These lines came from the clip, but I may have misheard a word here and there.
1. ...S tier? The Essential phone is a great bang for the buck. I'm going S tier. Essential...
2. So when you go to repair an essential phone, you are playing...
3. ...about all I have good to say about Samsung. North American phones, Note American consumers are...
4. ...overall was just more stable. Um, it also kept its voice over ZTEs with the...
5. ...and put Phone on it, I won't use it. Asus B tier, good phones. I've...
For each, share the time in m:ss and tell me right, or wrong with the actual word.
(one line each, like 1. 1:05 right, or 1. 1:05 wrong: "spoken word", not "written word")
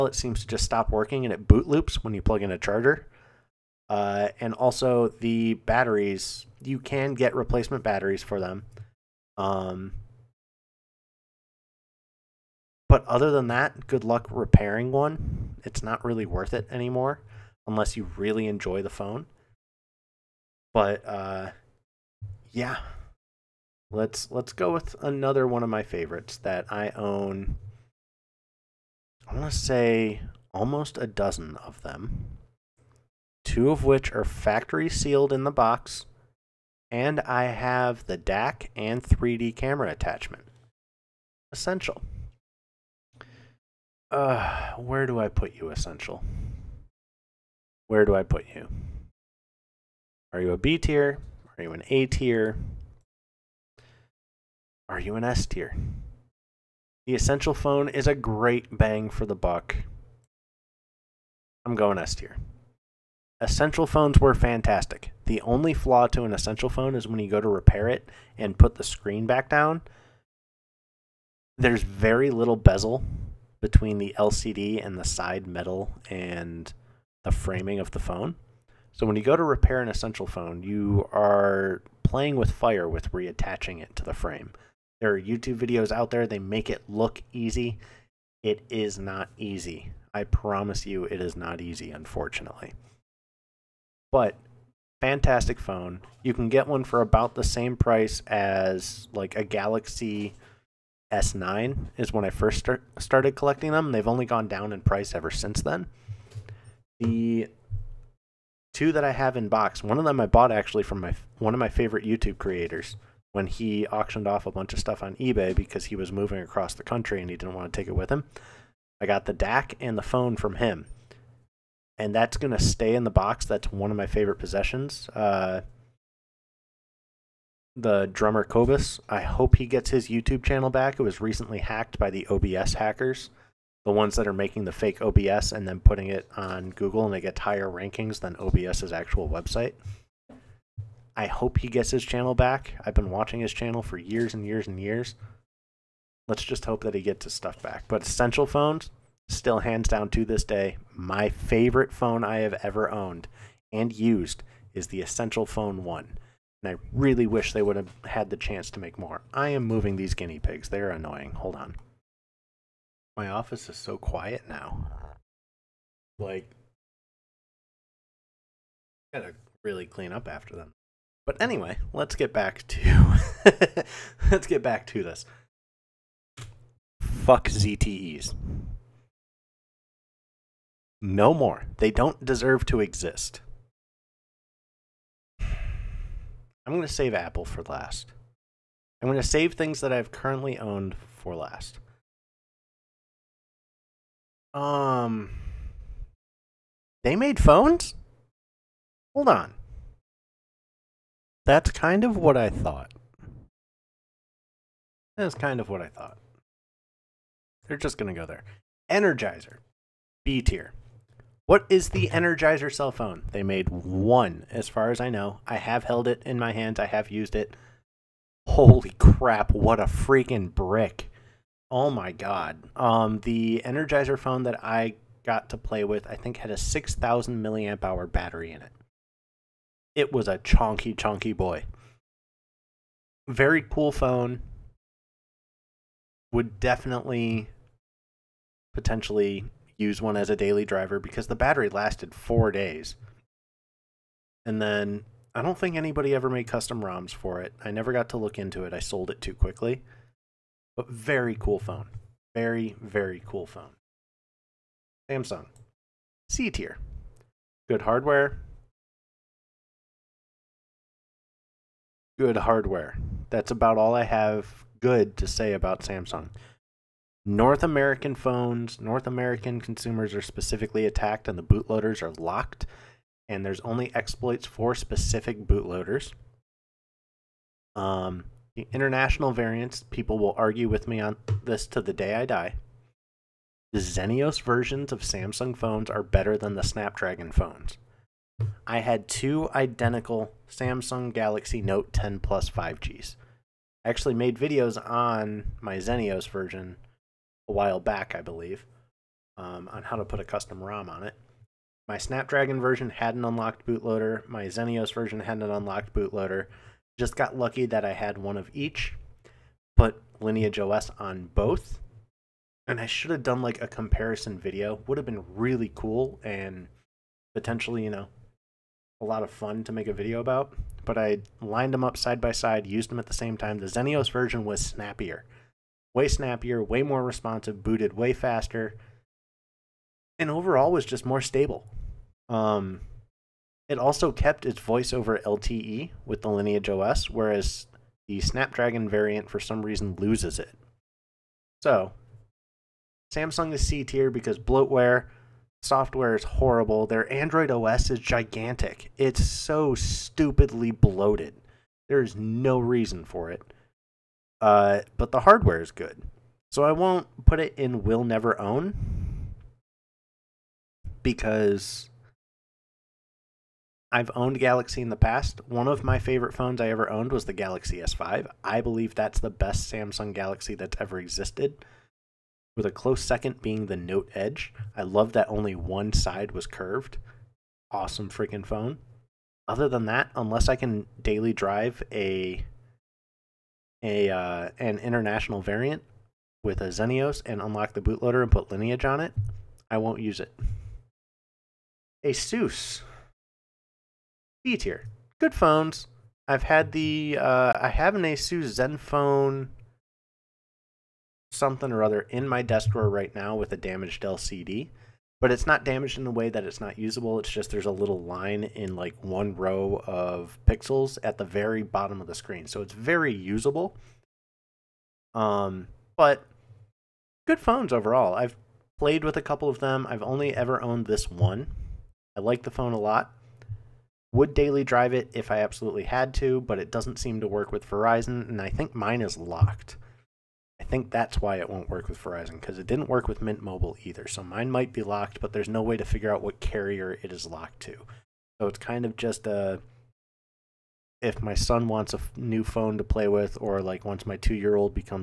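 1. 0:55 right
2. 1:18 right
3. 4:23 wrong: "North", not "Note"
4. 5:30 wrong: "LTE", not "ZTEs"
5. 6:28 wrong: "Lineage", not "Phone".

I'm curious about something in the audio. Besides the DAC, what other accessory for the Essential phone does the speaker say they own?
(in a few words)
3D camera attachment.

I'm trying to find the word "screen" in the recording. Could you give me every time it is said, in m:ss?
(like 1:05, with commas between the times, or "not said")
1:08, 6:52.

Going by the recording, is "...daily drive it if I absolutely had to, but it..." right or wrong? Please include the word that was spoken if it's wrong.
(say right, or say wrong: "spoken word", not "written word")
right.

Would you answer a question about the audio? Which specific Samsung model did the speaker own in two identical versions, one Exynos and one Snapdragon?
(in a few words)
Galaxy Note 10 Plus 5G.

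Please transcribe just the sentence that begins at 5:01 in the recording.
My Snapdragon version had an unlocked bootloader.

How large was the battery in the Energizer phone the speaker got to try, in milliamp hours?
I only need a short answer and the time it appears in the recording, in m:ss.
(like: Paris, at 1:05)
6,000, at 3:46.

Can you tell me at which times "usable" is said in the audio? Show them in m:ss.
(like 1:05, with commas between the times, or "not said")
6:46, 6:53.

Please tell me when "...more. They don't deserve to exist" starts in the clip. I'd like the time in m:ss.
3:01.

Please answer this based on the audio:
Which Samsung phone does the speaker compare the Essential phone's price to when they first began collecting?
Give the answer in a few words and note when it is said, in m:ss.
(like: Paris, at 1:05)
Galaxy S9, at 1:39.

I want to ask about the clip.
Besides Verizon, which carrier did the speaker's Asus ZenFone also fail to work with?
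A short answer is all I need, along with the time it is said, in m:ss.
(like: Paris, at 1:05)
Mint Mobile, at 7:13.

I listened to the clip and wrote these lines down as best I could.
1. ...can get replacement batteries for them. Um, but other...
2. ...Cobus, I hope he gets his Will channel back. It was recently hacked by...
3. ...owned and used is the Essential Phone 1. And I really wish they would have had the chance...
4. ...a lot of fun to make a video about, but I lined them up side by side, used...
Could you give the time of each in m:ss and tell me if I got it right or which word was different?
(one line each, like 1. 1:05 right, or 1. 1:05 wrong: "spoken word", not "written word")
1. 0:06 right
2. 2:08 wrong: "YouTube", not "Will"
3. 2:32 right
4. 5:19 right.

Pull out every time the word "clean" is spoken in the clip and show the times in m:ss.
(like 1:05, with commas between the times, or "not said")
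2:49.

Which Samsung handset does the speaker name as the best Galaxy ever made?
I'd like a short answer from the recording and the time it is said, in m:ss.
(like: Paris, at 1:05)
Galaxy S5, at 6:07.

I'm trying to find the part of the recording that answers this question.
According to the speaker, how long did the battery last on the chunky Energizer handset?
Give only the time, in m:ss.
4:02.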